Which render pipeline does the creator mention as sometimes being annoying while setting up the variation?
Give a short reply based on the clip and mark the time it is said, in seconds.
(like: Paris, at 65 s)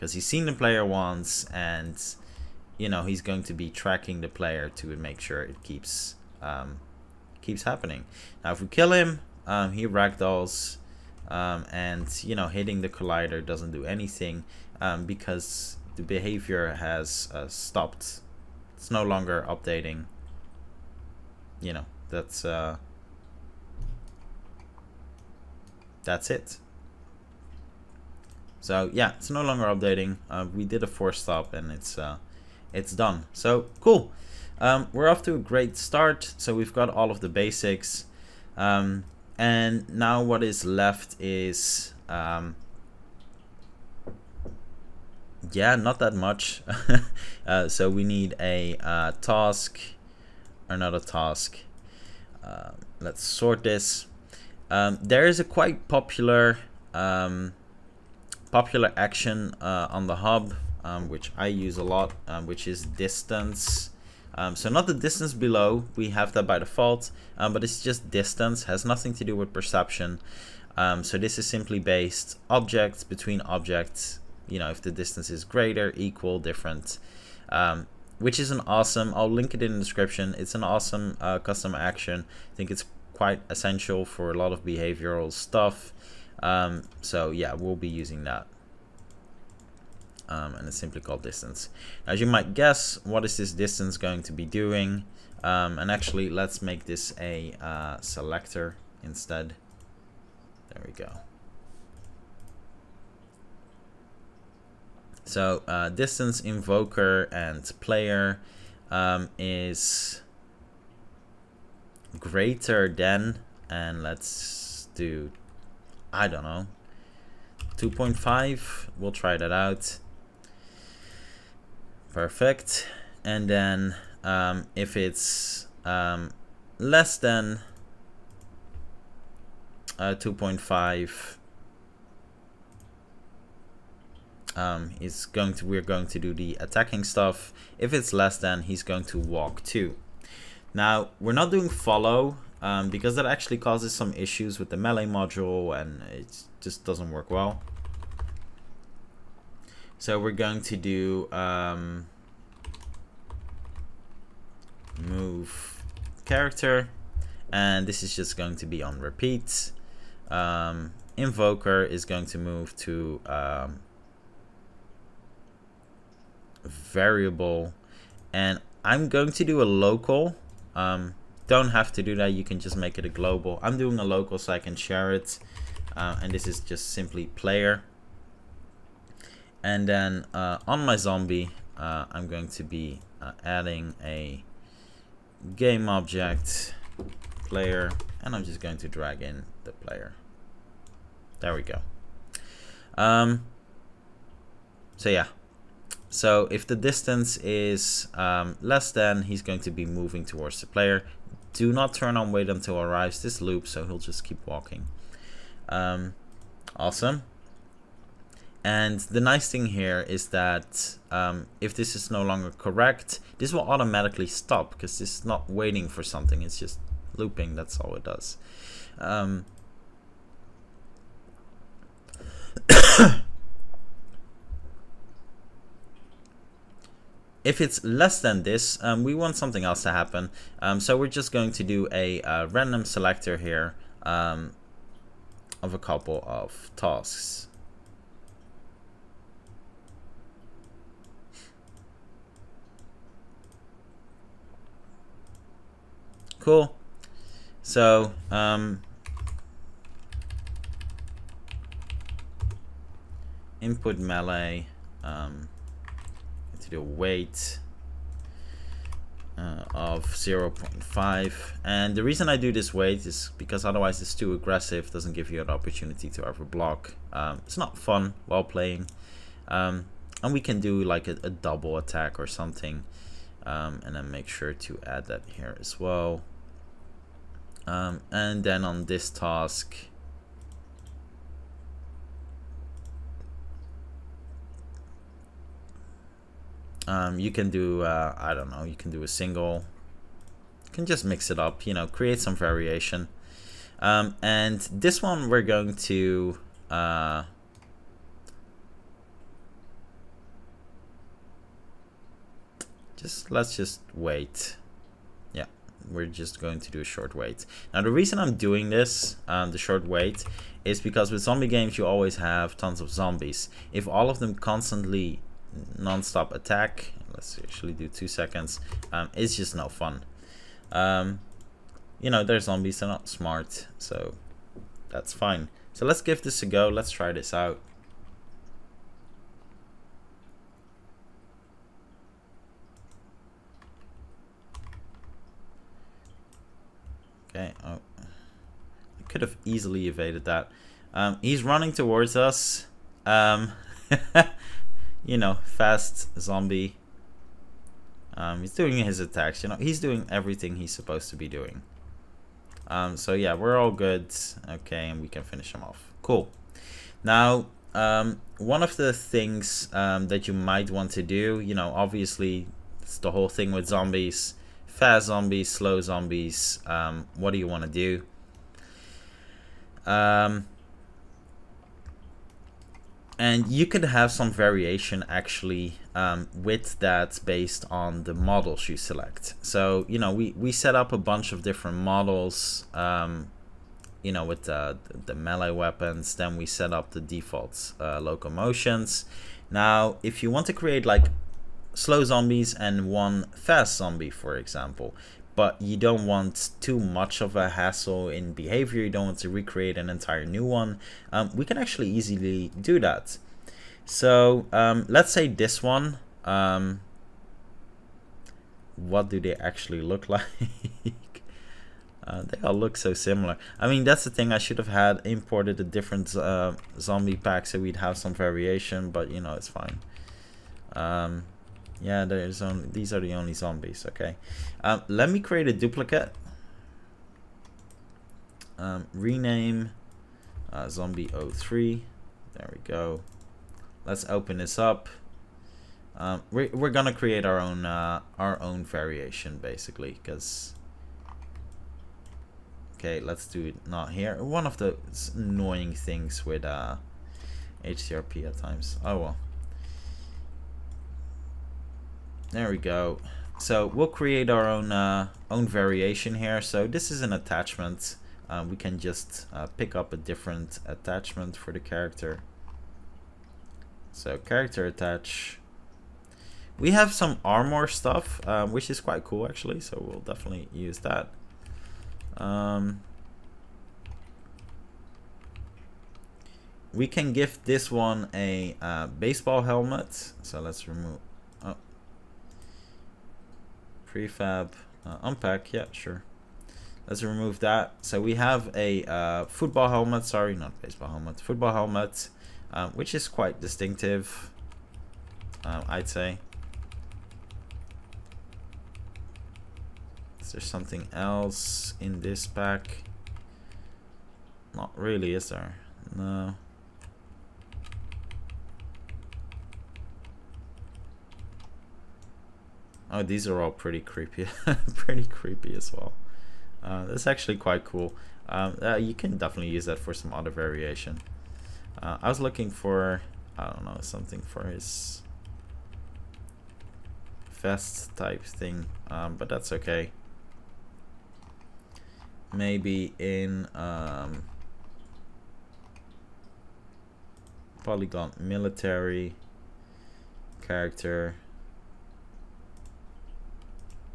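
HDRP, at 447 s.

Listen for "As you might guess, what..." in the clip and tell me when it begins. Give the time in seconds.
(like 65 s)
92 s.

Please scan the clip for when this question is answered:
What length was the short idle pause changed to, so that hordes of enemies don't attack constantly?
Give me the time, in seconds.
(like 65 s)
317 s.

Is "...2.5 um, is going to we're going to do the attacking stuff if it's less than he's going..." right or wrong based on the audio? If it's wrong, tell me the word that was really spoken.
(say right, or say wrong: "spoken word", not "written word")
right.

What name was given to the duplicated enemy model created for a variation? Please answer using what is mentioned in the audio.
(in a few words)
Zombie 03.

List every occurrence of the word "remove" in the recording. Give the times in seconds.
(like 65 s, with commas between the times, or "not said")
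480 s, 487 s.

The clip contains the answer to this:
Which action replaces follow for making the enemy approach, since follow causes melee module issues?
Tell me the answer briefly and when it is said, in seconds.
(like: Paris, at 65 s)
Move character, at 154 s.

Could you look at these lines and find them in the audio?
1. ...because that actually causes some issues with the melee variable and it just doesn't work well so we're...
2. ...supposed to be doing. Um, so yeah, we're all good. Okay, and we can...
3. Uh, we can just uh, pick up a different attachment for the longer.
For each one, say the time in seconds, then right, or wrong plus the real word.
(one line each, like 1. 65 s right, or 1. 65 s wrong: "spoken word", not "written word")
1. 142 s wrong: "module", not "variable"
2. 350 s right
3. 458 s wrong: "character", not "longer".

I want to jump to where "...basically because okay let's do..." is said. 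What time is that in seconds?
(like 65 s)
439 s.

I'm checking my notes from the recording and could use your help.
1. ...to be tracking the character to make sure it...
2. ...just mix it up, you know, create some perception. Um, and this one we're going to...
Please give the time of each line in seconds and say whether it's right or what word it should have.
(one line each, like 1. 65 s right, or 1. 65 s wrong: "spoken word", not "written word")
1. 3 s wrong: "player", not "character"
2. 290 s wrong: "variation", not "perception".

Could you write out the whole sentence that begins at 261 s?
And the reason I do this wait is because otherwise it's too aggressive, doesn't give you an opportunity to ever block.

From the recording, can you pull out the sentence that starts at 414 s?
I should have had imported a different uh, zombie pack so we'd have some variation, but you know, it's fine.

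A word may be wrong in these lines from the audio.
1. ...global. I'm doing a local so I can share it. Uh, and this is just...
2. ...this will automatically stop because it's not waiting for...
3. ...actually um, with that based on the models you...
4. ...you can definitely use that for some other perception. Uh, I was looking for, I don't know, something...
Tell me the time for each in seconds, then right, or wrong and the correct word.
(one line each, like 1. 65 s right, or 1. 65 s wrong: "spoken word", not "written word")
1. 173 s right
2. 213 s right
3. 375 s right
4. 518 s wrong: "variation", not "perception".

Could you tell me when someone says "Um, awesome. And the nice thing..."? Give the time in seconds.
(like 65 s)
205 s.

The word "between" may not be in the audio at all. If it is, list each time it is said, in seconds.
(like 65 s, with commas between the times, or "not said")
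73 s.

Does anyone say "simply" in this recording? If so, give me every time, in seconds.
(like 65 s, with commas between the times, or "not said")
71 s, 90 s, 176 s.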